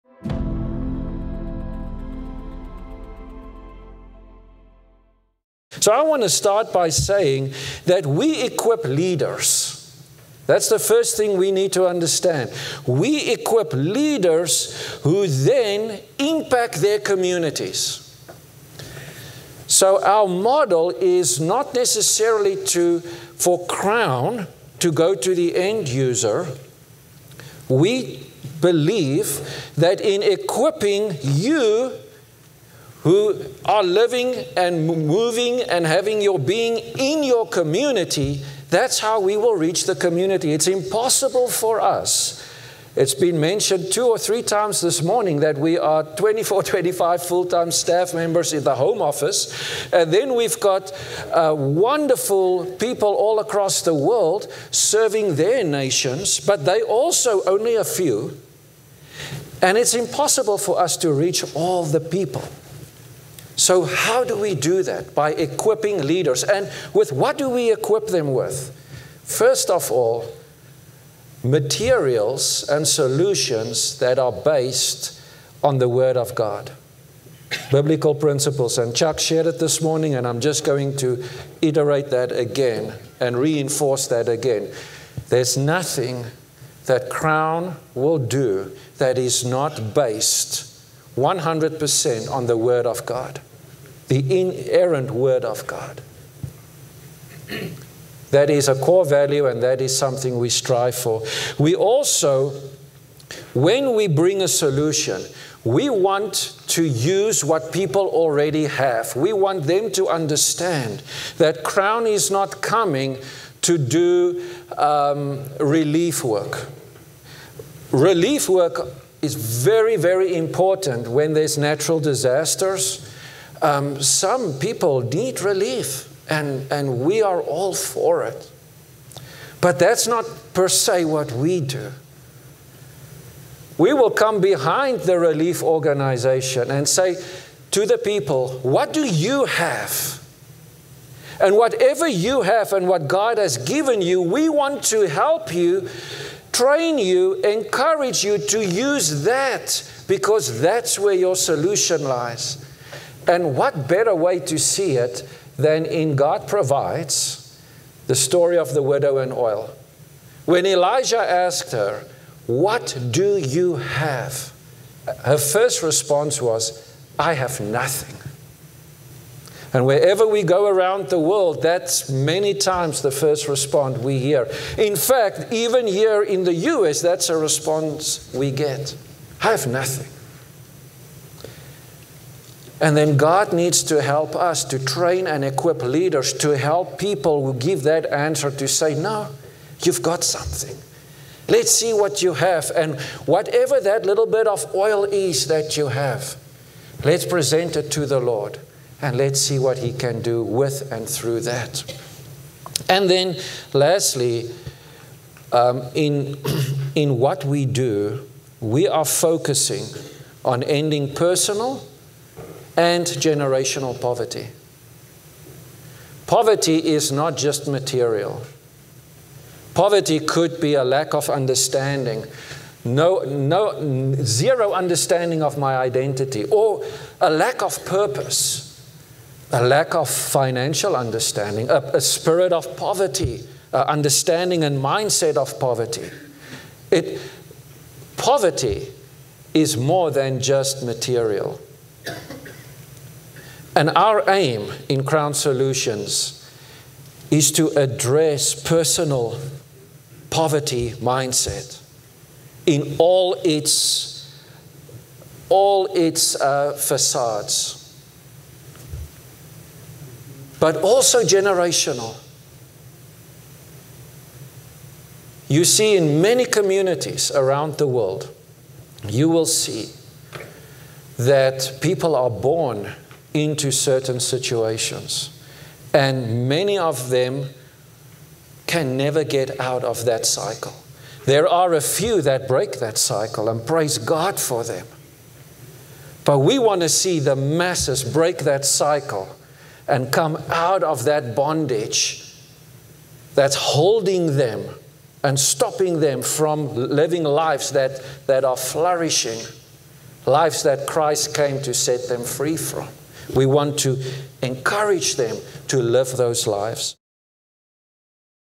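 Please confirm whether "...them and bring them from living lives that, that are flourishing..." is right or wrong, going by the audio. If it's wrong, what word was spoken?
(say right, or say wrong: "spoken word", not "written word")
wrong: "stopping", not "bring".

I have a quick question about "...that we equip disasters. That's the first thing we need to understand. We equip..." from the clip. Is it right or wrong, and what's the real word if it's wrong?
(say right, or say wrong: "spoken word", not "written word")
wrong: "leaders", not "disasters".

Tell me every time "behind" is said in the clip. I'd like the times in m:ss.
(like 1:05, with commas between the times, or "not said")
2:14.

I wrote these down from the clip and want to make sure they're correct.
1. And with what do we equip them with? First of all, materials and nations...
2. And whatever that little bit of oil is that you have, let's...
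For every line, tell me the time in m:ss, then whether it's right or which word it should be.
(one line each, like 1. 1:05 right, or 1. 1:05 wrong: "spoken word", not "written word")
1. 1:06 wrong: "solutions", not "nations"
2. 3:12 right.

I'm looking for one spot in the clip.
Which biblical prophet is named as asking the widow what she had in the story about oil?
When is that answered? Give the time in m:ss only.
2:40.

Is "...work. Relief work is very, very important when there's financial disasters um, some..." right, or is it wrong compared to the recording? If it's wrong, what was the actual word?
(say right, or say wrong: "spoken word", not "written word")
wrong: "natural", not "financial".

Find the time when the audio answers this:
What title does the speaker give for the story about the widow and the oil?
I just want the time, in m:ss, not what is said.
2:36.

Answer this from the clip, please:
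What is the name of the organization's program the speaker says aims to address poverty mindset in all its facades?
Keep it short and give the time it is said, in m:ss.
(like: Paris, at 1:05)
Crown Solutions, at 4:05.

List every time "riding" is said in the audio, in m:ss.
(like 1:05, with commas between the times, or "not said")
not said.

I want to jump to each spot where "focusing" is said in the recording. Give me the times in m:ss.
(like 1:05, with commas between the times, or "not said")
3:29.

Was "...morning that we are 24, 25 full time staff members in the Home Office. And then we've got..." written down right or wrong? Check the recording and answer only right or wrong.
right.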